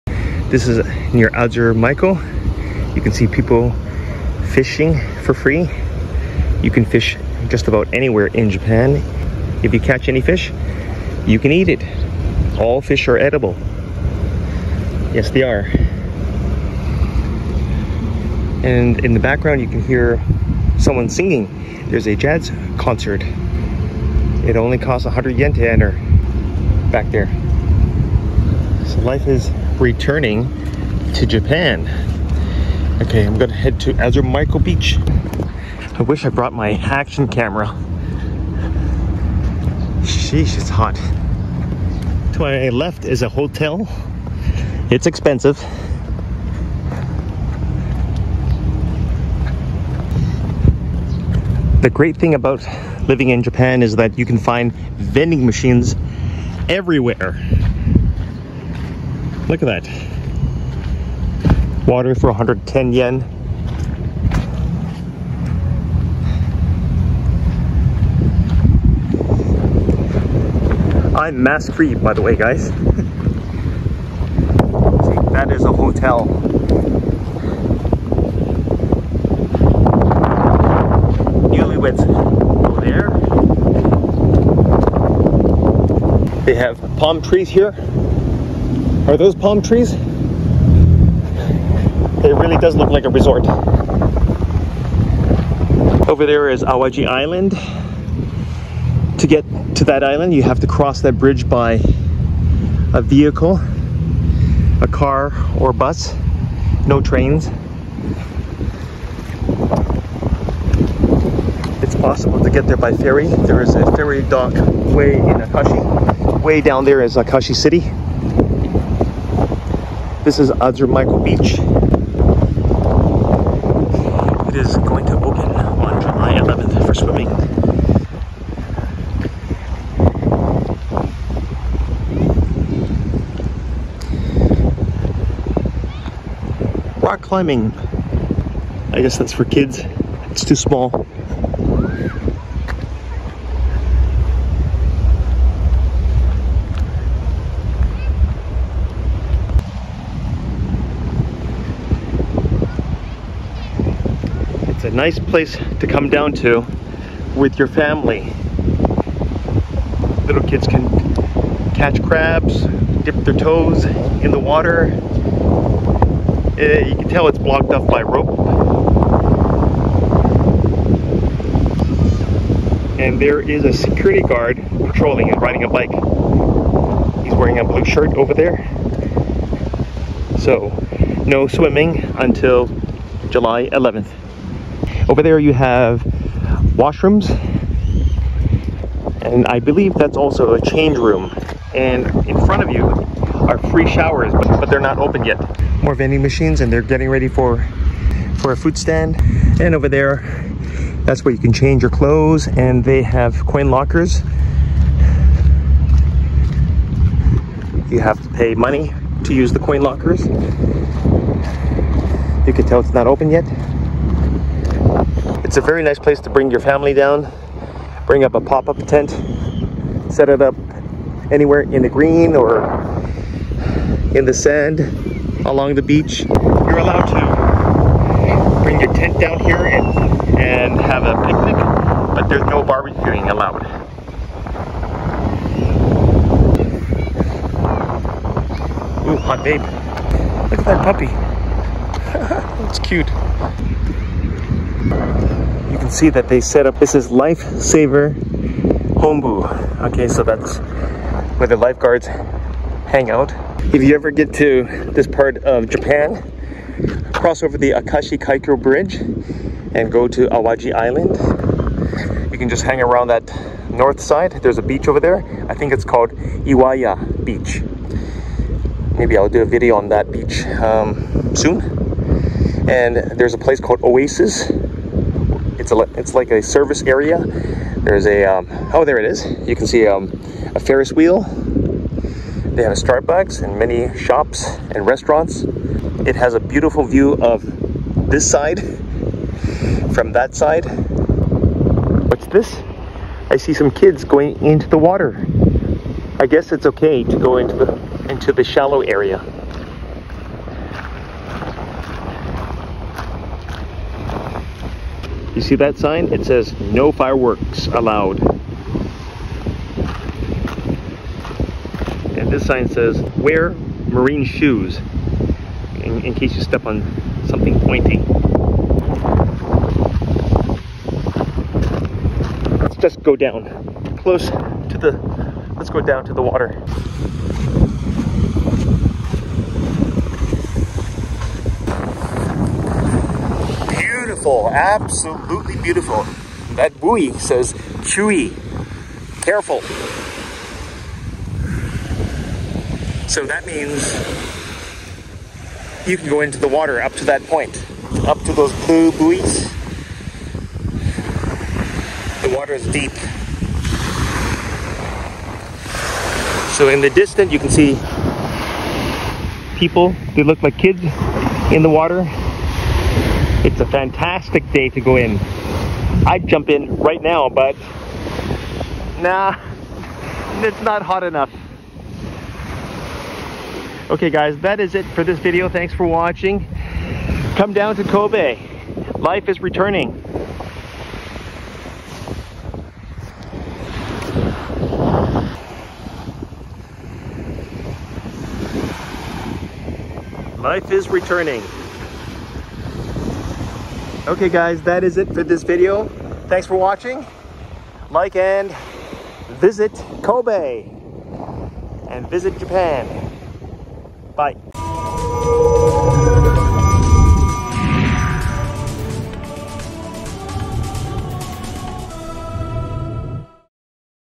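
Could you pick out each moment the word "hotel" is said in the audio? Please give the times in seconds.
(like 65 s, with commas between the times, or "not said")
43 s, 75 s.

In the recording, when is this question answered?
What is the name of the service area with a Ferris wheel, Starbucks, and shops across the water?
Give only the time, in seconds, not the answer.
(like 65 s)
273 s.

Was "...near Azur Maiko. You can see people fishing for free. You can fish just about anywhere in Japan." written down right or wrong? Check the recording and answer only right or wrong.
right.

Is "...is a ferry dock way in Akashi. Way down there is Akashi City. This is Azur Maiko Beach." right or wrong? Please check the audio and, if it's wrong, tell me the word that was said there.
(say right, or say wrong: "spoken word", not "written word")
right.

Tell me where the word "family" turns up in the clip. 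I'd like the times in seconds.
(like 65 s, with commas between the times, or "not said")
157 s, 216 s.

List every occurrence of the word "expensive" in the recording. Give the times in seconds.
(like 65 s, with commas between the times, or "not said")
45 s.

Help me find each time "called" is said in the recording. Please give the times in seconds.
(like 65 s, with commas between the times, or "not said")
265 s, 273 s.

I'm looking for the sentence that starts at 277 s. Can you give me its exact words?
There's a um, oh there it is.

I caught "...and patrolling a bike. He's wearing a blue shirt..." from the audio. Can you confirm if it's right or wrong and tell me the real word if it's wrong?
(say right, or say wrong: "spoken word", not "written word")
wrong: "riding", not "patrolling".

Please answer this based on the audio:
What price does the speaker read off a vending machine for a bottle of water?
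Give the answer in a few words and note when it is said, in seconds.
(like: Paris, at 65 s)
110 yen, at 62 s.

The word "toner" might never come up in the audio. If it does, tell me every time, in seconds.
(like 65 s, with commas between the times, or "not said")
not said.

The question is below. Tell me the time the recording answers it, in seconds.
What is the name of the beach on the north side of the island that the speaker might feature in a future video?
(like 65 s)
266 s.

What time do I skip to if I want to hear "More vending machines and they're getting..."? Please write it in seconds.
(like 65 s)
195 s.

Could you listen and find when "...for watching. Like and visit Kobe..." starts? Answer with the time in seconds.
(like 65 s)
396 s.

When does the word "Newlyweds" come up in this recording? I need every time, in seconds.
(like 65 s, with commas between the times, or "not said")
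81 s.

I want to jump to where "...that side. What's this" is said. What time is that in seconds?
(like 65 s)
290 s.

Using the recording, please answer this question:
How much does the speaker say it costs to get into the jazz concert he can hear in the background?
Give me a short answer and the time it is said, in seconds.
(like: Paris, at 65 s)
100 yen, at 25 s.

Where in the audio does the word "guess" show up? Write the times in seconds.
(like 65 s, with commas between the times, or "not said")
139 s, 296 s.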